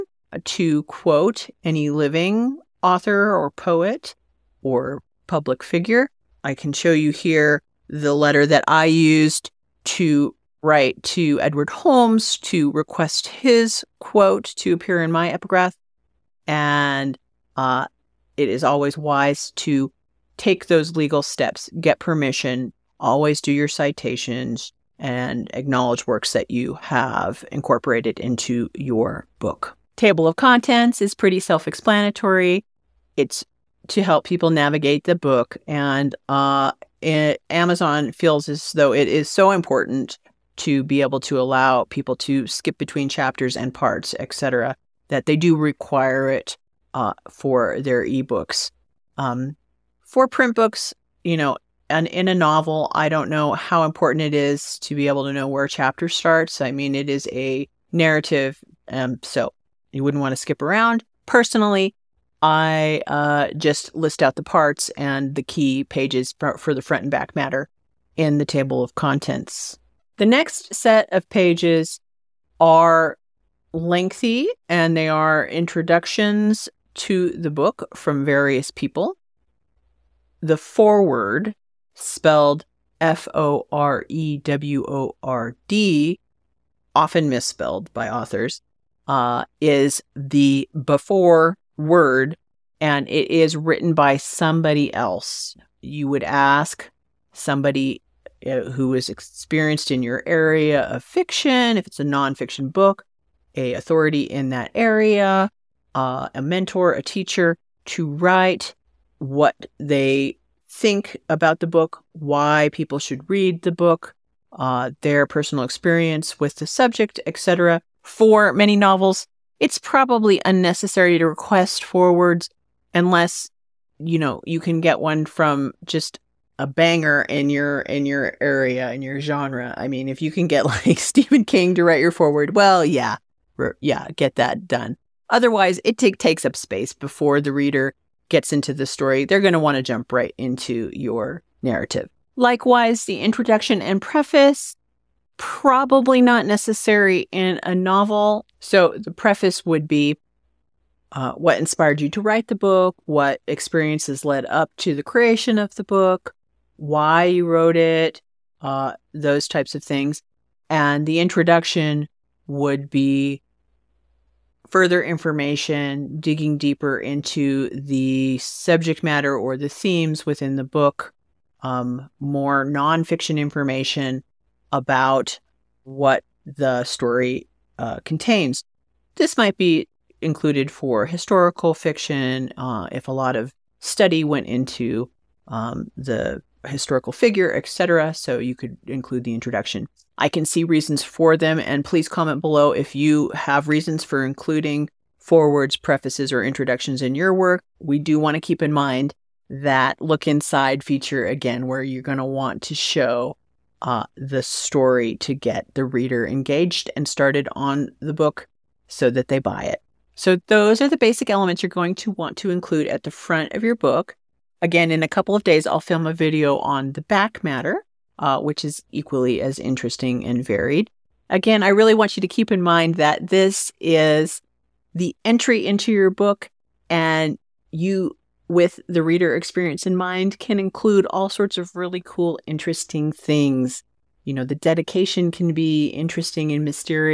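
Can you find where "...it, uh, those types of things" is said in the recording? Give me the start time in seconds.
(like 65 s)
157 s.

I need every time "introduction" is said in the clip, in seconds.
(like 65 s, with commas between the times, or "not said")
75 s, 143 s, 161 s, 189 s, 196 s.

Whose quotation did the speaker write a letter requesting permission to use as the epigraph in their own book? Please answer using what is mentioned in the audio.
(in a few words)
Edward Holmes.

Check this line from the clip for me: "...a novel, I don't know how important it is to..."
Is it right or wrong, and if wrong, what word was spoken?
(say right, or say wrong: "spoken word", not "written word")
right.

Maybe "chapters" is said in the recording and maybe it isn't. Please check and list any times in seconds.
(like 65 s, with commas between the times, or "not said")
43 s, 55 s.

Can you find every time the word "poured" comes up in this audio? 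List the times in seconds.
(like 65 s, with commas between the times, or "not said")
not said.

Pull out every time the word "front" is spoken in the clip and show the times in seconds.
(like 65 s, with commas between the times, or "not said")
66 s, 213 s.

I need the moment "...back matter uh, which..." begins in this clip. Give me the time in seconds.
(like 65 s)
217 s.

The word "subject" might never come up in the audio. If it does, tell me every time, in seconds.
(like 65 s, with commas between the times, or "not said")
116 s, 168 s.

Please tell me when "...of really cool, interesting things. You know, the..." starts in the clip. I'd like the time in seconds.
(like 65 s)
231 s.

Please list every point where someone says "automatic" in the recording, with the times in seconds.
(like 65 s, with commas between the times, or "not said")
not said.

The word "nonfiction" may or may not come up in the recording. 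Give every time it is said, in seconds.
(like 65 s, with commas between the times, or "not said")
102 s, 172 s.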